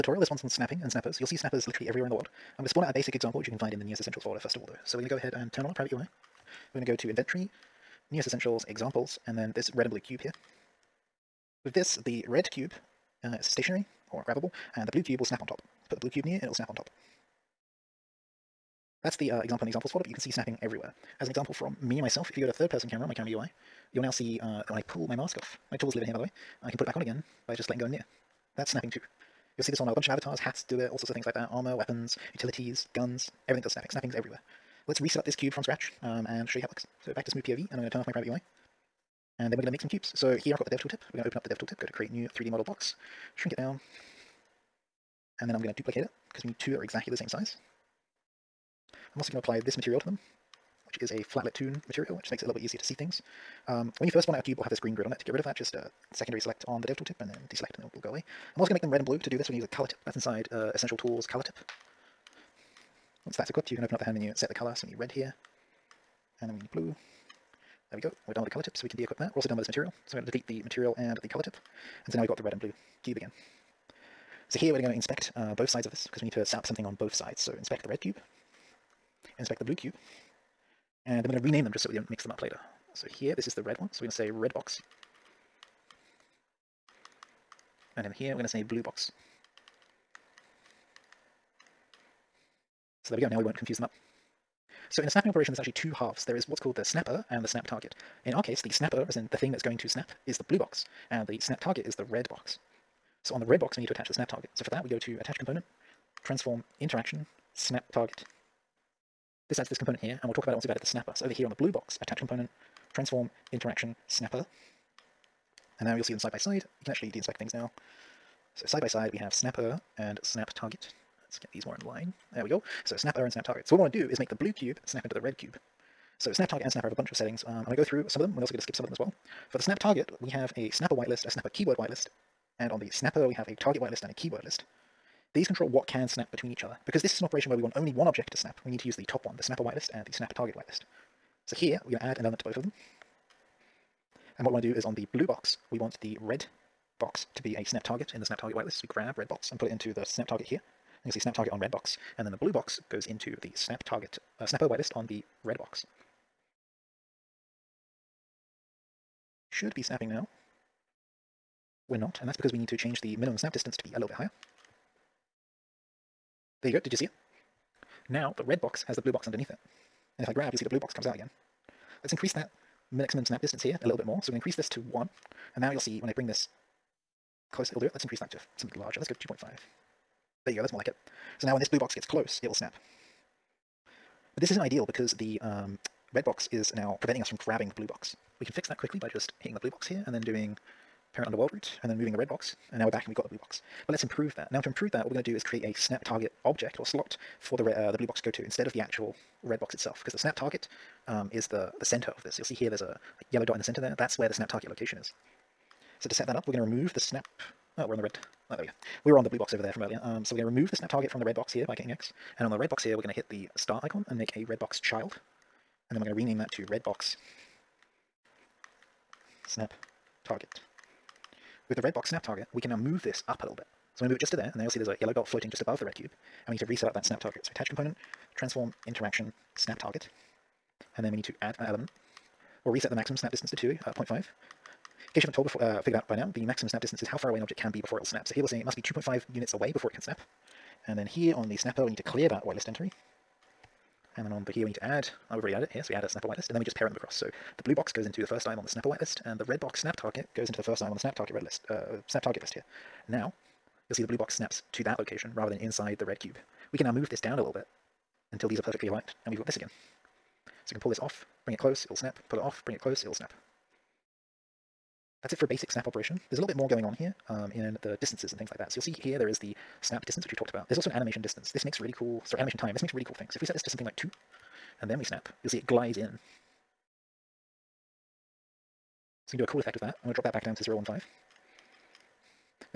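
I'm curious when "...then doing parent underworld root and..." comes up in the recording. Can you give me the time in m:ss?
3:10.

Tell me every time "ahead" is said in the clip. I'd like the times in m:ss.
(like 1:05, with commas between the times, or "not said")
0:05.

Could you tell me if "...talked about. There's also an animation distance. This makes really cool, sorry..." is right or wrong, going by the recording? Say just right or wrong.
right.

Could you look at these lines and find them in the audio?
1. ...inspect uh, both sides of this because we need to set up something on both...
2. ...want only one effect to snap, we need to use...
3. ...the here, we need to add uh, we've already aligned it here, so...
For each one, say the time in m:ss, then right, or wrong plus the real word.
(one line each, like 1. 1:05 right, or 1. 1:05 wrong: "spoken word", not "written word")
1. 1:14 right
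2. 2:17 wrong: "object", not "effect"
3. 4:04 wrong: "added", not "aligned".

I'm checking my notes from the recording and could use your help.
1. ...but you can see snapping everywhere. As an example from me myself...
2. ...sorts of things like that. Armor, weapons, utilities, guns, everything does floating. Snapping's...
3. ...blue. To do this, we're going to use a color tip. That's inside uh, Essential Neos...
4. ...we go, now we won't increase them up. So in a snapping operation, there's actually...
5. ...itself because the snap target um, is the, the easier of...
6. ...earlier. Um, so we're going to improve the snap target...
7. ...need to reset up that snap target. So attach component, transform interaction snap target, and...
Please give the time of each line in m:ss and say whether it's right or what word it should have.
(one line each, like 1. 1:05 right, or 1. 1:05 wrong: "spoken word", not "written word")
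1. 0:20 right
2. 0:30 wrong: "snapping", not "floating"
3. 0:59 wrong: "Tools", not "Neos"
4. 1:33 wrong: "confuse", not "increase"
5. 3:19 wrong: "center", not "easier"
6. 3:29 wrong: "remove", not "improve"
7. 3:46 right.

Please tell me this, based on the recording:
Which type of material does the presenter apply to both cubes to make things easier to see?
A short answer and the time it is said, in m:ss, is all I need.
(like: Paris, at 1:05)
FlatLitToon, at 0:51.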